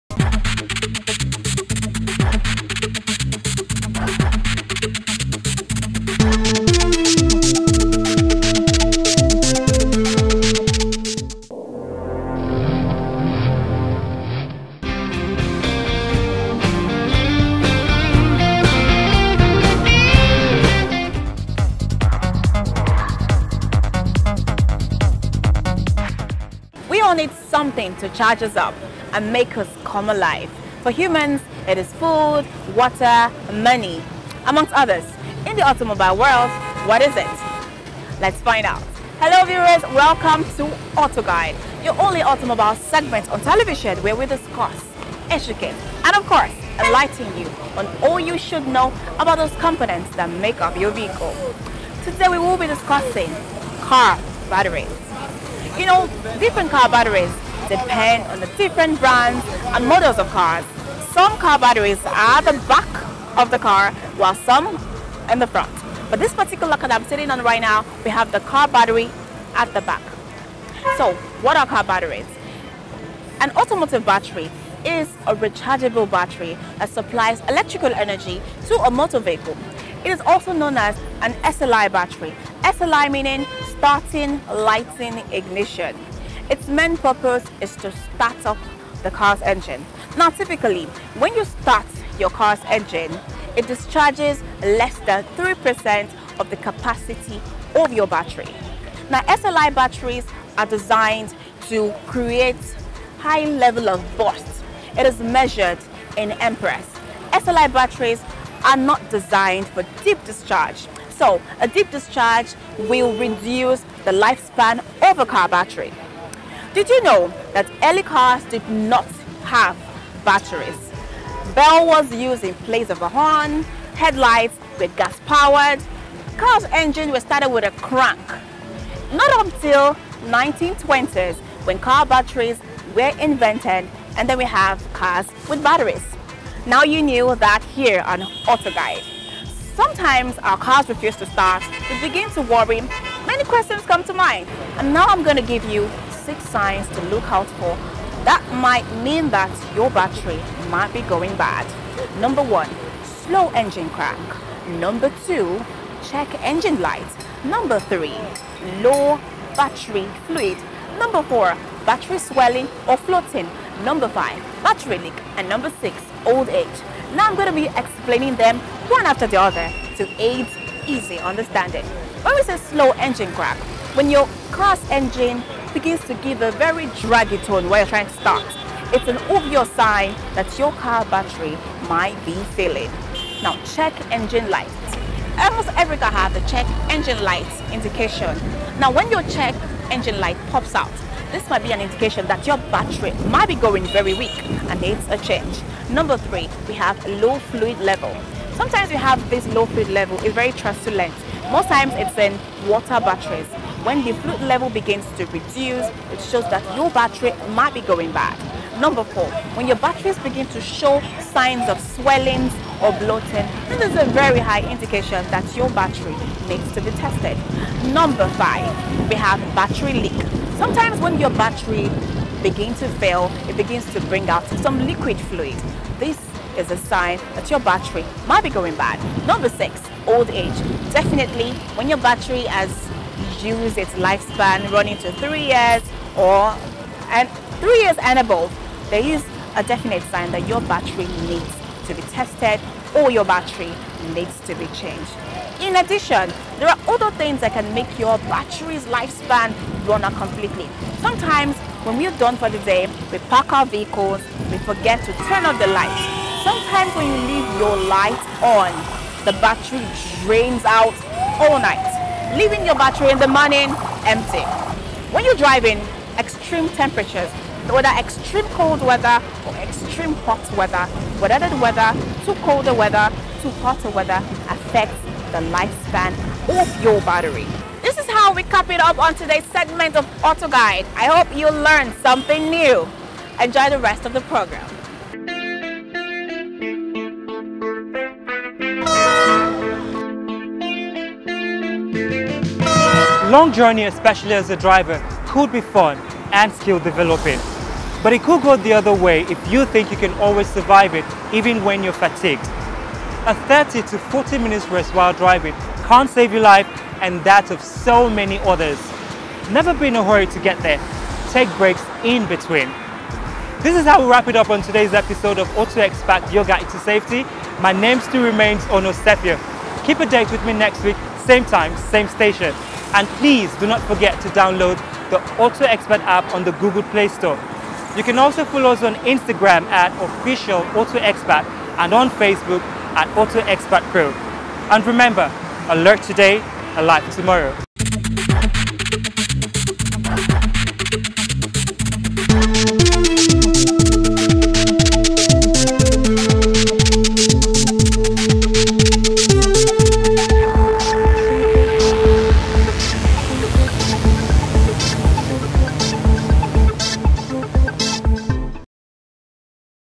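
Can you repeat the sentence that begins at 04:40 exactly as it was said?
I hope you learned something new.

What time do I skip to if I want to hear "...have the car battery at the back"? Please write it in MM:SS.
01:08.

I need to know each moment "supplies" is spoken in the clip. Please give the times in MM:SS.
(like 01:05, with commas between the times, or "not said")
01:16.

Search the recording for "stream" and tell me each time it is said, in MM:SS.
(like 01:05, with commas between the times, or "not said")
not said.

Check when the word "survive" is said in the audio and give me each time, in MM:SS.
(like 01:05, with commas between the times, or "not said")
05:00.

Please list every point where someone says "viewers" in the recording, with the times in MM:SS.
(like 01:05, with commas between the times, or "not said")
00:39.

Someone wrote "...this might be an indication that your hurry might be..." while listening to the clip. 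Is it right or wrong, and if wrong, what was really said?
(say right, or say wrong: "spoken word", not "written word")
wrong: "battery", not "hurry".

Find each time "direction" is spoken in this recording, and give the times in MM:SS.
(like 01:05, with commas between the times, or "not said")
not said.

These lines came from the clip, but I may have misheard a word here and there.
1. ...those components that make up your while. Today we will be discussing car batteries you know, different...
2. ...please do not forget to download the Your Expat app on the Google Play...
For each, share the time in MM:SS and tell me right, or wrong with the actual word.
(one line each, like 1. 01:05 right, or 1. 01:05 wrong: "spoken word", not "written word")
1. 00:49 wrong: "vehicle", not "while"
2. 05:23 wrong: "Auto", not "Your".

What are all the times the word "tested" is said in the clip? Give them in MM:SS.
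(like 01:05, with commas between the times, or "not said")
03:36, 04:02.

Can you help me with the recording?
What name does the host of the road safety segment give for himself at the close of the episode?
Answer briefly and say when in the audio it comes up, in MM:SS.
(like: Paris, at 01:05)
Ono Sepia, at 05:18.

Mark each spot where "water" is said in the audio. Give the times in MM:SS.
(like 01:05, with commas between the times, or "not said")
00:32, 03:22.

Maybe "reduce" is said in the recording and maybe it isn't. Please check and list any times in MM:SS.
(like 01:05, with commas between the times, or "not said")
01:53, 03:25.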